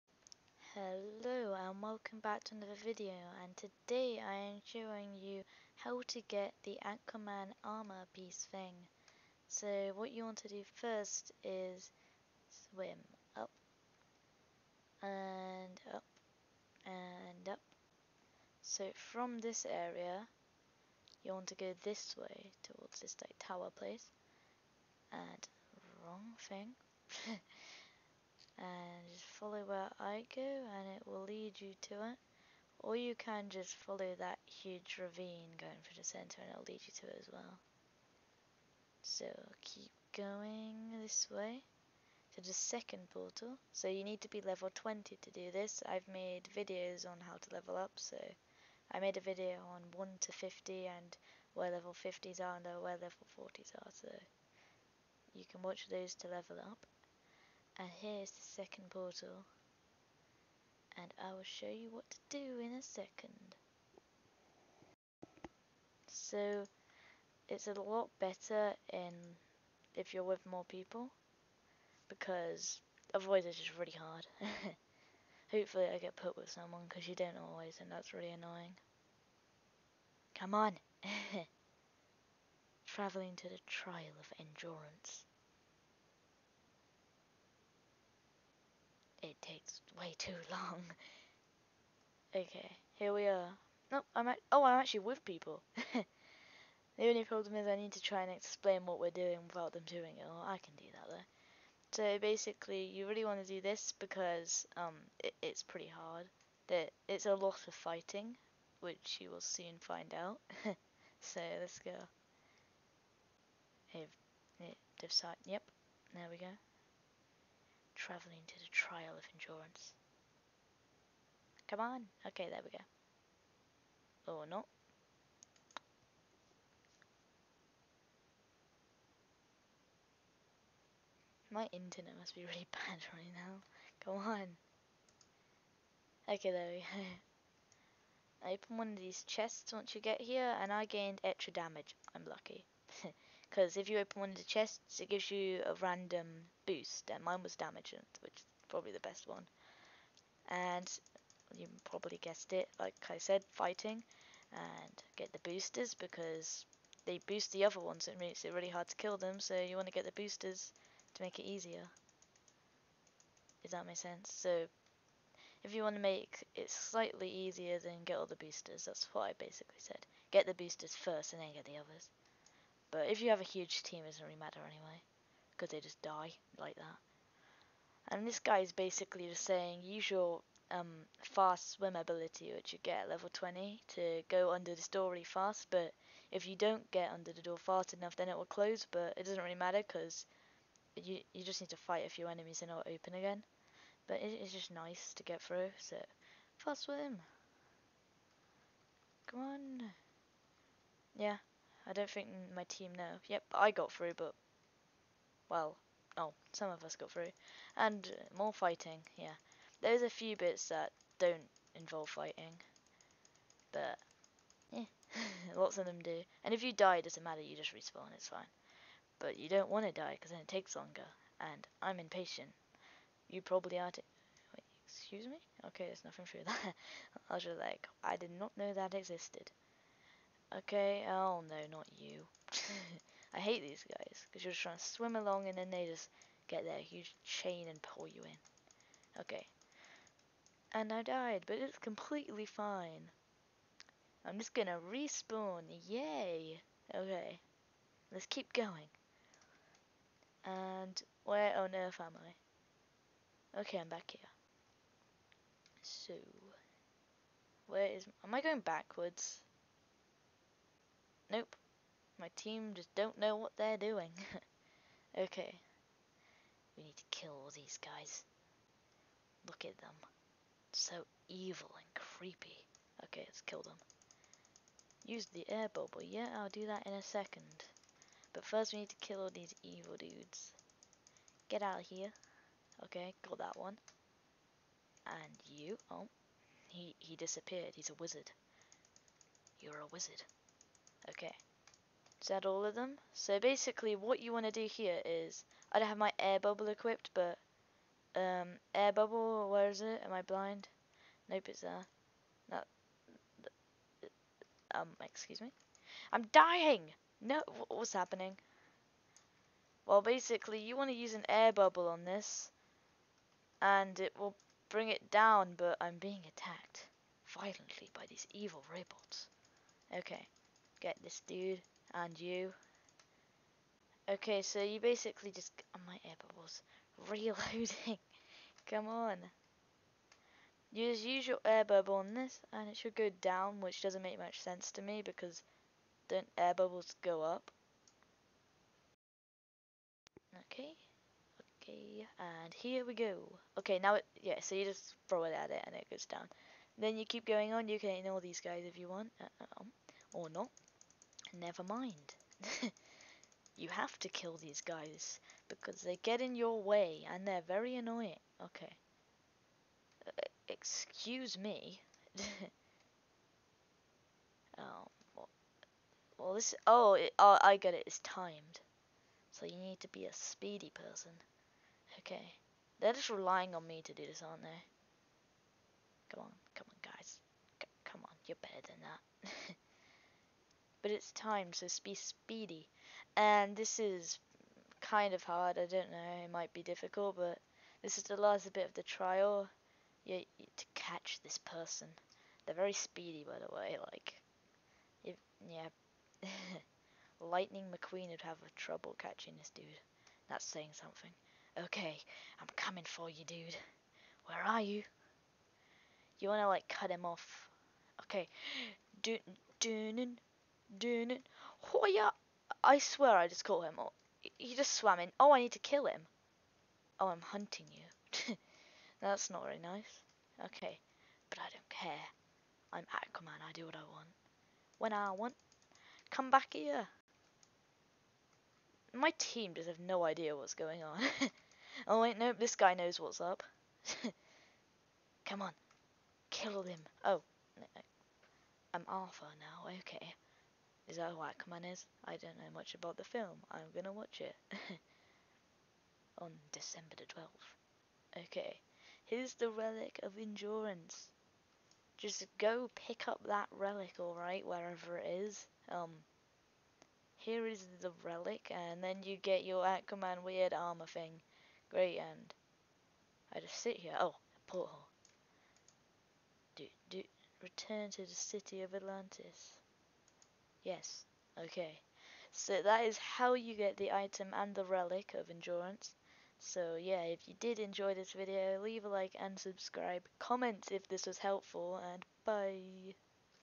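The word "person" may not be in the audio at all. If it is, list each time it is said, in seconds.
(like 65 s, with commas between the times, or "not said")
370 s, 391 s.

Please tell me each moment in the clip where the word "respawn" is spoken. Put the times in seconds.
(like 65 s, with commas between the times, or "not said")
217 s, 244 s.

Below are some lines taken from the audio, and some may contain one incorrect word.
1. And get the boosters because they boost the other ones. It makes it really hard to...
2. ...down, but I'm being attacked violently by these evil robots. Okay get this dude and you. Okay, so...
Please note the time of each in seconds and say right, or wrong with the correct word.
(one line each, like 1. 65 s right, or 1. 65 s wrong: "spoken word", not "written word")
1. 154 s right
2. 315 s right.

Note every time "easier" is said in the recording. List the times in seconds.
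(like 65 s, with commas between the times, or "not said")
161 s, 167 s.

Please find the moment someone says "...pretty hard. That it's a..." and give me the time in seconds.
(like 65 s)
105 s.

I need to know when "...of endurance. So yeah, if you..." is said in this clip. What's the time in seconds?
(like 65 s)
475 s.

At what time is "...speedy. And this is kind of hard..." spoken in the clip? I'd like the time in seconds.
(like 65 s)
381 s.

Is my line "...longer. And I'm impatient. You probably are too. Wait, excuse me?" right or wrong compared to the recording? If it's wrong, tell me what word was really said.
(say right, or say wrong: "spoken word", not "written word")
right.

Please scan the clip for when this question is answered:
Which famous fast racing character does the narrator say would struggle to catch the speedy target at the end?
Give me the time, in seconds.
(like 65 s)
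397 s.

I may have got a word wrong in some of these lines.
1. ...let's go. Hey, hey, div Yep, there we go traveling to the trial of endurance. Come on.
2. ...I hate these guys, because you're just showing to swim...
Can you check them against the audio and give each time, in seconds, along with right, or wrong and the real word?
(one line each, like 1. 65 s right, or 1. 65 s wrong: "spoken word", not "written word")
1. 111 s right
2. 233 s wrong: "trying", not "showing".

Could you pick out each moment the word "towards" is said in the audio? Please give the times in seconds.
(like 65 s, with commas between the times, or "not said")
22 s.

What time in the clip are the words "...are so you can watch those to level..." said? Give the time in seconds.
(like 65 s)
53 s.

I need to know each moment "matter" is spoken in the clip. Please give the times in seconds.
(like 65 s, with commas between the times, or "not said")
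174 s, 189 s, 217 s.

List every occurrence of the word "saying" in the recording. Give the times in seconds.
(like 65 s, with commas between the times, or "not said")
179 s, 400 s.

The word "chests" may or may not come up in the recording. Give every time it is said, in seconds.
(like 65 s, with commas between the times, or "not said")
139 s, 144 s.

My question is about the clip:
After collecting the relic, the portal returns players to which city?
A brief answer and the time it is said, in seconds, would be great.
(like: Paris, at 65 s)
Atlantis, at 468 s.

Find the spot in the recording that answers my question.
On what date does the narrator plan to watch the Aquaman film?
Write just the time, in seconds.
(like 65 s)
446 s.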